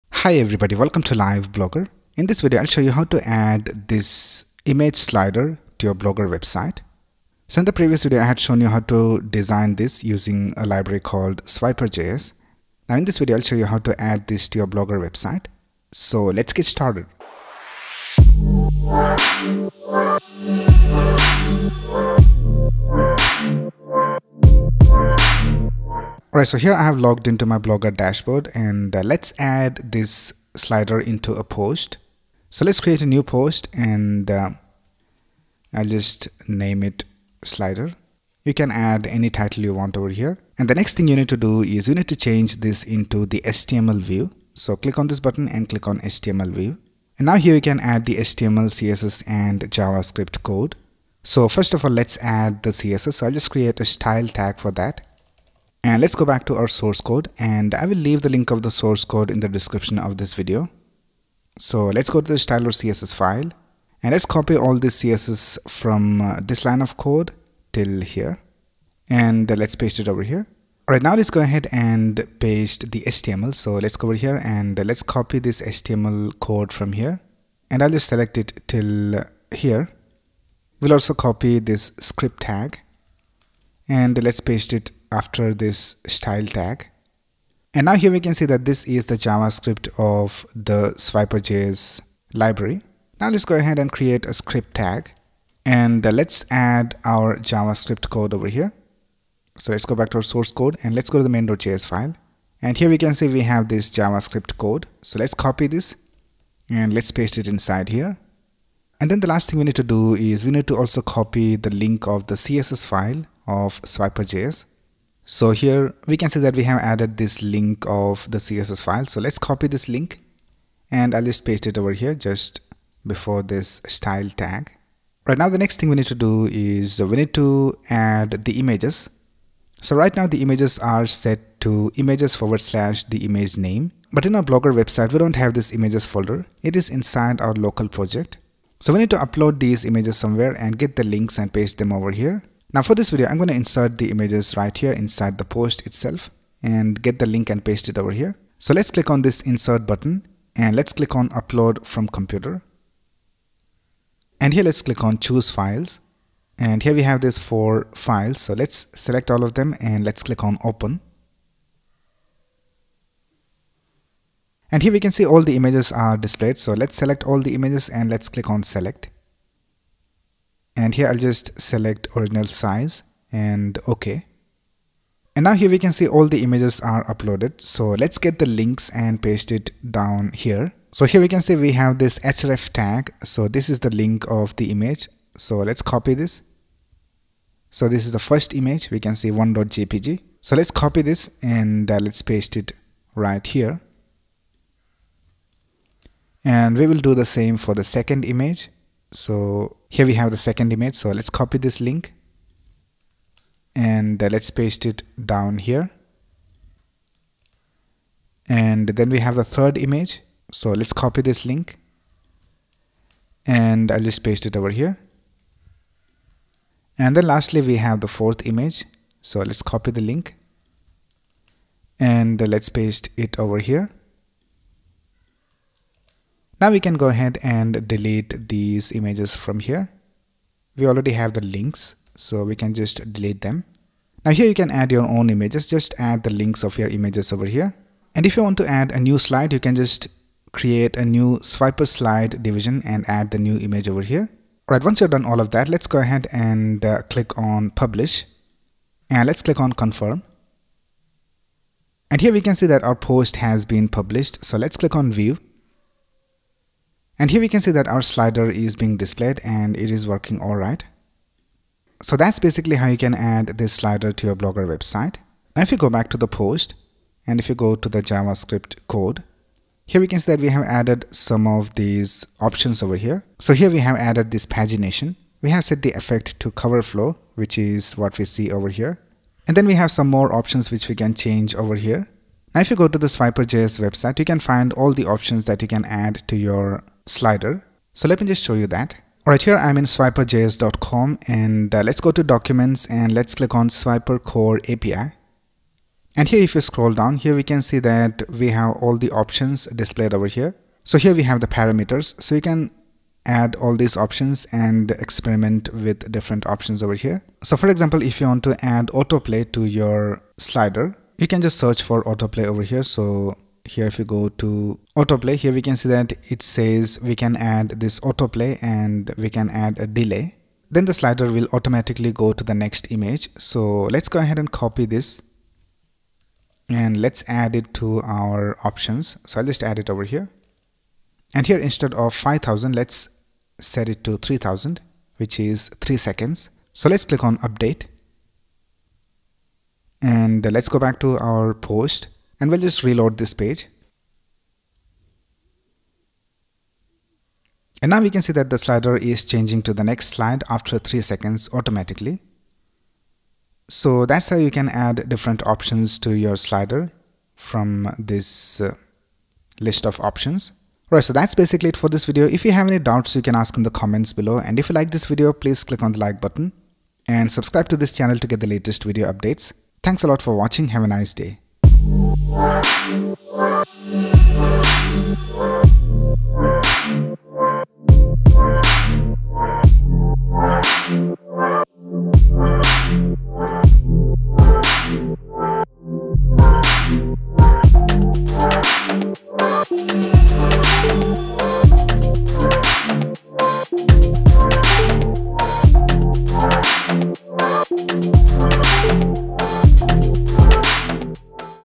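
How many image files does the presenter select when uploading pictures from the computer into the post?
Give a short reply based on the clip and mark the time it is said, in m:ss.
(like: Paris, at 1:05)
4, at 2:37.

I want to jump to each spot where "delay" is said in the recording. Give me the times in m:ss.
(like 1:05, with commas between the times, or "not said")
5:19.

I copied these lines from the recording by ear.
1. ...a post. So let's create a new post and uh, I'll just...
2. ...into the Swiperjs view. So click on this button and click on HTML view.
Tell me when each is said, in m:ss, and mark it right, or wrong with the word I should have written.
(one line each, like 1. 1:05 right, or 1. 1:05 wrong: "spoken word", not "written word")
1. 0:31 right
2. 0:42 wrong: "HTML", not "Swiperjs".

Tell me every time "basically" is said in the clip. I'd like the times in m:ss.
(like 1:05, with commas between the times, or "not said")
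4:22, 6:01.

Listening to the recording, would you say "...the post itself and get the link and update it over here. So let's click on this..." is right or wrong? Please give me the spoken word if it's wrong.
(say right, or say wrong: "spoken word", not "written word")
wrong: "paste", not "update".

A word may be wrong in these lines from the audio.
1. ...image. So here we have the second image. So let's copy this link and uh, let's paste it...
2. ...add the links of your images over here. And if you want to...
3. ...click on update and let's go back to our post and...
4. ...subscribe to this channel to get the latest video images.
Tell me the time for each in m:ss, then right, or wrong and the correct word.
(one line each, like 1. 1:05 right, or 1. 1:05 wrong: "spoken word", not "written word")
1. 3:18 right
2. 3:55 right
3. 5:37 right
4. 6:07 wrong: "updates", not "images".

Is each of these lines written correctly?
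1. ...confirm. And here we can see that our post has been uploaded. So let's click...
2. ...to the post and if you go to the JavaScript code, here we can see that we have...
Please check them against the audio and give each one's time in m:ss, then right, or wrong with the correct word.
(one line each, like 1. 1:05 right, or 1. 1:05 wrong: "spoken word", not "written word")
1. 4:09 wrong: "published", not "uploaded"
2. 4:26 right.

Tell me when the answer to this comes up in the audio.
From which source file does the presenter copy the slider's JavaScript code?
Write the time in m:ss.
1:41.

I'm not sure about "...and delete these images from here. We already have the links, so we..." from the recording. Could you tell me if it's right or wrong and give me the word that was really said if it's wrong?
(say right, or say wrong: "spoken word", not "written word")
right.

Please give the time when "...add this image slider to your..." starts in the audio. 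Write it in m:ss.
0:03.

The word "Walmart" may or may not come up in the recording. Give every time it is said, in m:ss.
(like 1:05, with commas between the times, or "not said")
not said.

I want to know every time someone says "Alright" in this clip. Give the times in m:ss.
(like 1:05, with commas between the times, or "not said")
0:26, 4:04, 4:49.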